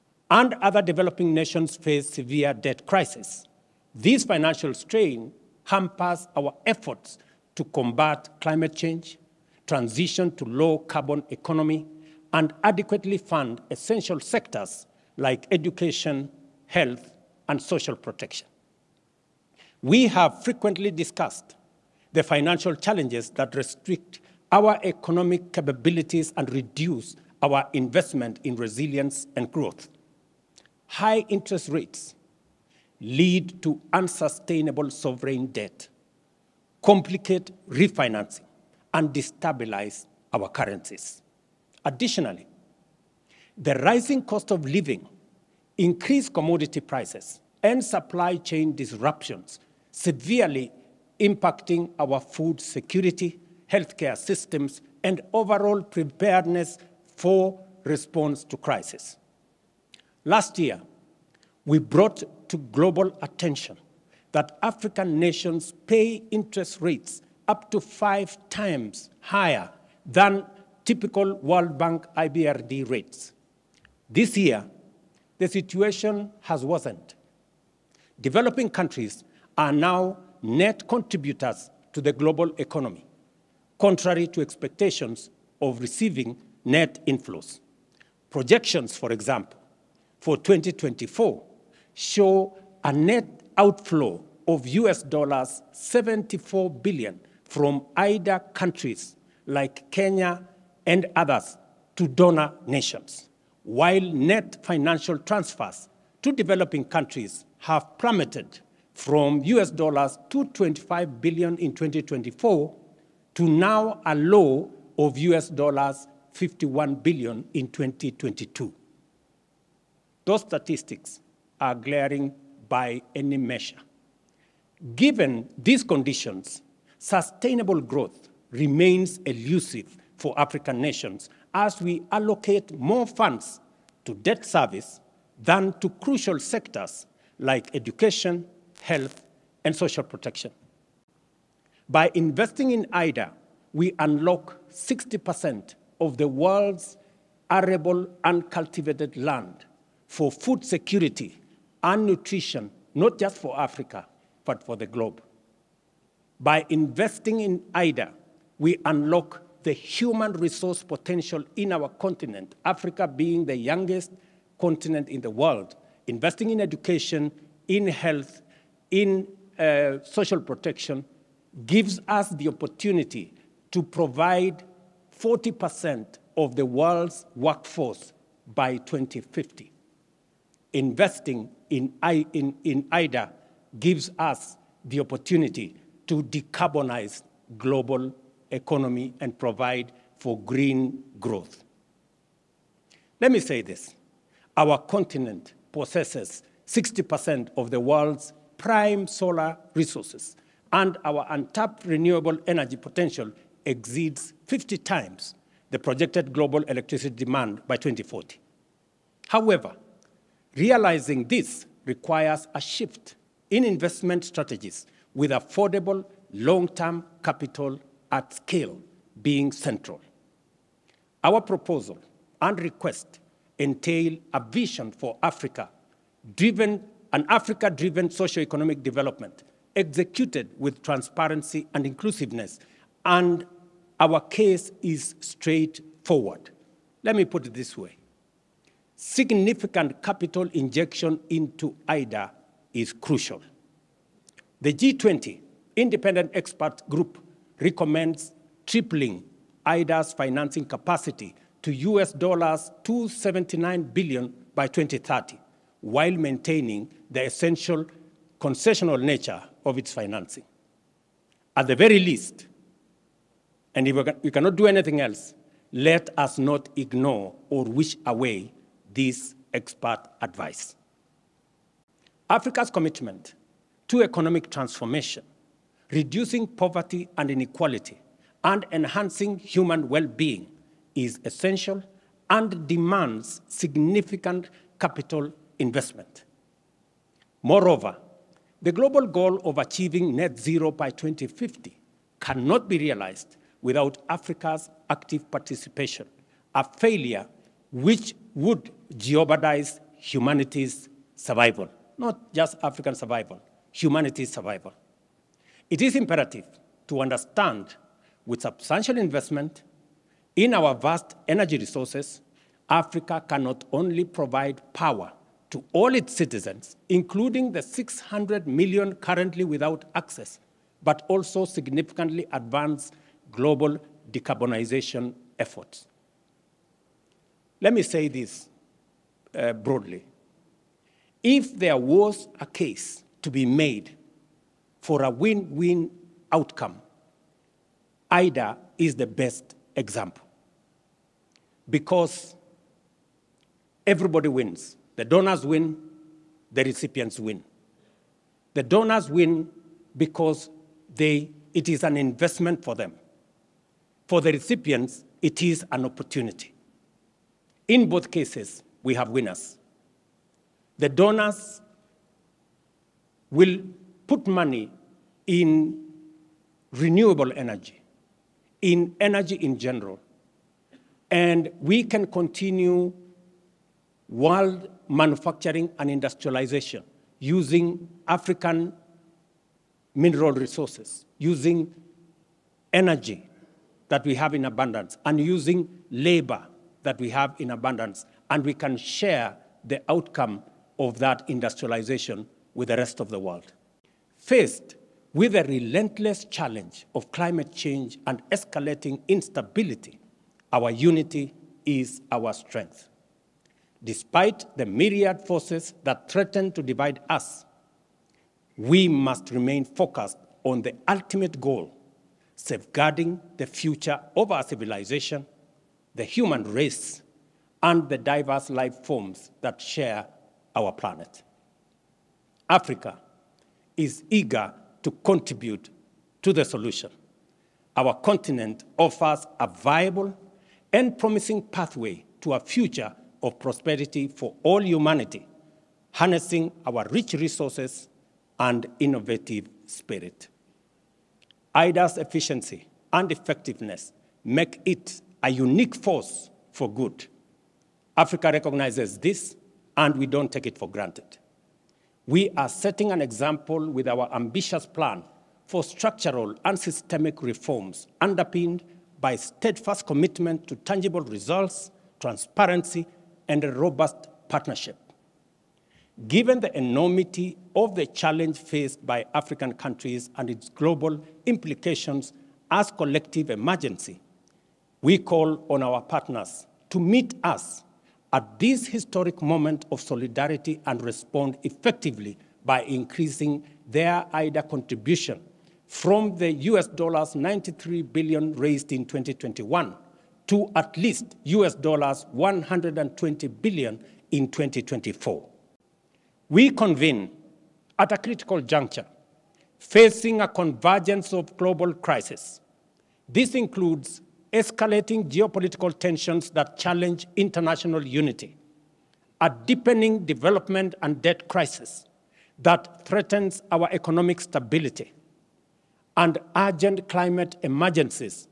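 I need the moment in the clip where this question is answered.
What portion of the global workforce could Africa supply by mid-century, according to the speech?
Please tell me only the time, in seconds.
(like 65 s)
175 s.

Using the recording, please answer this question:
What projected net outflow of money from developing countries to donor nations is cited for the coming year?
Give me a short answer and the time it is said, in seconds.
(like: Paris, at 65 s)
$74 billion, at 94 s.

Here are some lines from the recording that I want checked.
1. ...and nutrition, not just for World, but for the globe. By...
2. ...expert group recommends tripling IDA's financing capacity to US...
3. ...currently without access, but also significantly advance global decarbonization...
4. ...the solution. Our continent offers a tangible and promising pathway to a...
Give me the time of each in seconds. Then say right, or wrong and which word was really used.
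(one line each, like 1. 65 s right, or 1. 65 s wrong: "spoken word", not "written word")
1. 151 s wrong: "Africa", not "World"
2. 246 s right
3. 318 s right
4. 426 s wrong: "viable", not "tangible".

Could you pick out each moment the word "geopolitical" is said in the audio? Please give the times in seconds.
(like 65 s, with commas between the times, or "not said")
505 s.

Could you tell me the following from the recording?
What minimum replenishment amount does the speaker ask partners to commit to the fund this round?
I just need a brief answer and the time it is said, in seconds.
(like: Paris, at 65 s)
$120 billion, at 491 s.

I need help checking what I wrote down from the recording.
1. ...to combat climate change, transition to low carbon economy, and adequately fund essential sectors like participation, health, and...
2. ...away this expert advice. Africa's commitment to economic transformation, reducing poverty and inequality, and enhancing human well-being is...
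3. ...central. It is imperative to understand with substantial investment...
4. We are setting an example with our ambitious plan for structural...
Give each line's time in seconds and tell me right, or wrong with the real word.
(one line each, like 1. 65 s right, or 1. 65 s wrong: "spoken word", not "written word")
1. 7 s wrong: "education", not "participation"
2. 268 s right
3. 304 s wrong: "survival", not "central"
4. 452 s right.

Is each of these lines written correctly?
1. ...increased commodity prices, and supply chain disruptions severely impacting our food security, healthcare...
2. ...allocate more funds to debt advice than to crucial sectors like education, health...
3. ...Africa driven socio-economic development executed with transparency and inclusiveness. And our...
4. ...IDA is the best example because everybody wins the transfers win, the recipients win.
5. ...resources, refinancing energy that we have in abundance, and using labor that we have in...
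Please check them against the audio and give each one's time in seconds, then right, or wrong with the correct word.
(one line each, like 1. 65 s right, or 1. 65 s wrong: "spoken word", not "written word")
1. 45 s right
2. 132 s wrong: "service", not "advice"
3. 227 s right
4. 338 s wrong: "donors", not "transfers"
5. 380 s wrong: "using", not "refinancing".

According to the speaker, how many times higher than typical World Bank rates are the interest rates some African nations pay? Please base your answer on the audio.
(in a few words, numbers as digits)
5 times.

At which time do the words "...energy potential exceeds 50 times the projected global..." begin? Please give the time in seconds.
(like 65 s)
202 s.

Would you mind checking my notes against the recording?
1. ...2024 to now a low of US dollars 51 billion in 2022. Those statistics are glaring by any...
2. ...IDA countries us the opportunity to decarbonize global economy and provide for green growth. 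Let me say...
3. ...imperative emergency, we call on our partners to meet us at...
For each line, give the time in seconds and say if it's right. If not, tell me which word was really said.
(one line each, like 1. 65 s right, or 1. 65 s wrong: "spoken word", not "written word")
1. 111 s right
2. 182 s wrong: "gives", not "countries"
3. 472 s wrong: "collective", not "imperative".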